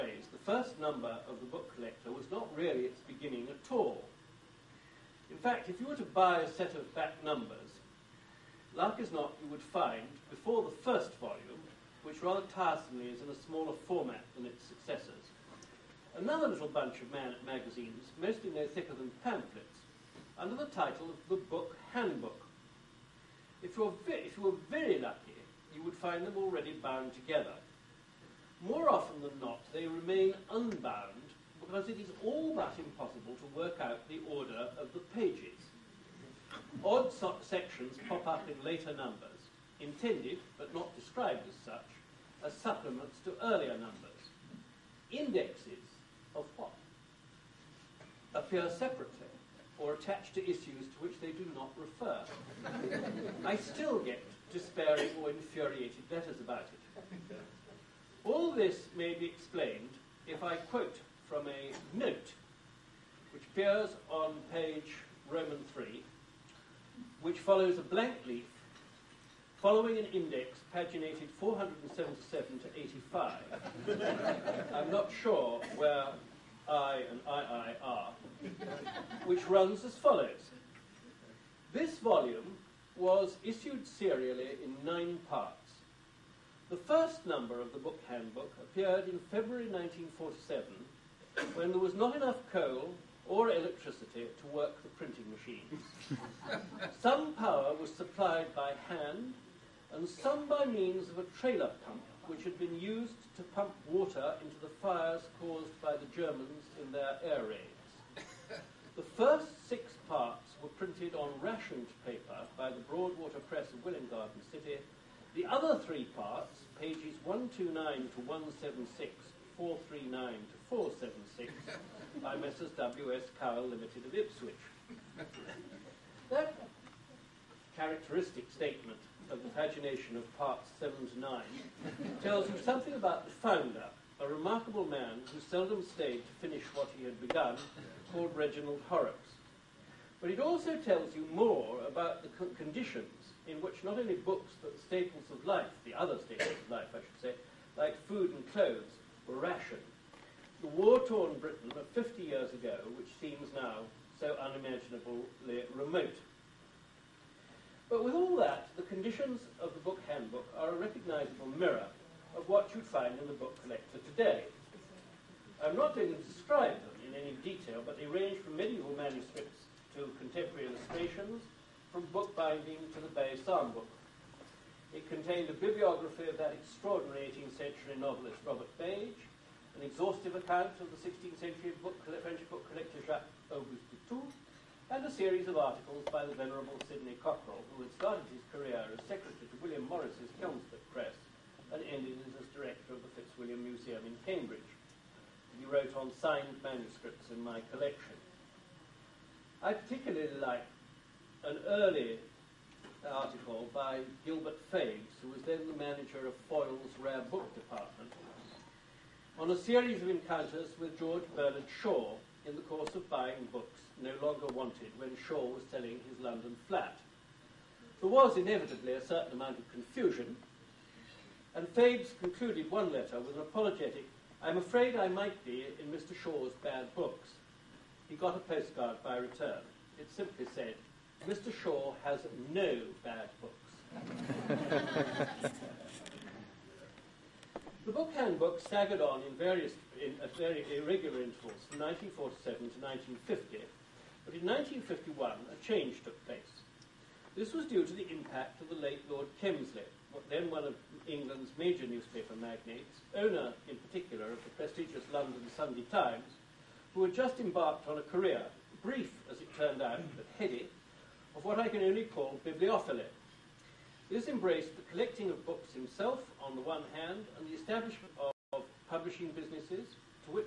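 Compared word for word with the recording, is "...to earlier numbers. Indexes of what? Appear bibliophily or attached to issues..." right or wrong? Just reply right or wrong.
wrong.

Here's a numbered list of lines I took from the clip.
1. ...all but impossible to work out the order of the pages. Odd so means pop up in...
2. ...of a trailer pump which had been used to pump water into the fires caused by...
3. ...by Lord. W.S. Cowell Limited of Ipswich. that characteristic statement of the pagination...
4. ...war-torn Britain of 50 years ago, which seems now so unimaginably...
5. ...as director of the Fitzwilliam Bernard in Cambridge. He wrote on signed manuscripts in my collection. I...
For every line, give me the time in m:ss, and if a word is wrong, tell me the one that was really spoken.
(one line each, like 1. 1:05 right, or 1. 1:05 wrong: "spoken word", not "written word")
1. 0:32 wrong: "sections", not "means"
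2. 1:41 right
3. 2:02 wrong: "Messrs", not "Lord"
4. 2:30 right
5. 3:12 wrong: "Museum", not "Bernard".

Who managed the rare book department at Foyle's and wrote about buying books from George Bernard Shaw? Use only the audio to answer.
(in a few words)
Gilbert Fabes.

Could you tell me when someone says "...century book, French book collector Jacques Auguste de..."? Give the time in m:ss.
3:01.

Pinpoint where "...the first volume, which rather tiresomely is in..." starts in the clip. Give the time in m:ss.
0:10.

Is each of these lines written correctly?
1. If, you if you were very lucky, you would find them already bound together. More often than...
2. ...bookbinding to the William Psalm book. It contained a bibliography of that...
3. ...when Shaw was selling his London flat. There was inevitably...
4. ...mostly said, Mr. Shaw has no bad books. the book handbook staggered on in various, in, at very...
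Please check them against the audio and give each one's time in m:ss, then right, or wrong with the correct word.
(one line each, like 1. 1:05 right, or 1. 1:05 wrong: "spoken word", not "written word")
1. 0:23 right
2. 2:52 wrong: "Bay", not "William"
3. 3:34 right
4. 3:50 wrong: "simply", not "mostly".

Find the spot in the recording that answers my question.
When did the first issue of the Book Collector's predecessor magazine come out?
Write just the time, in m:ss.
1:29.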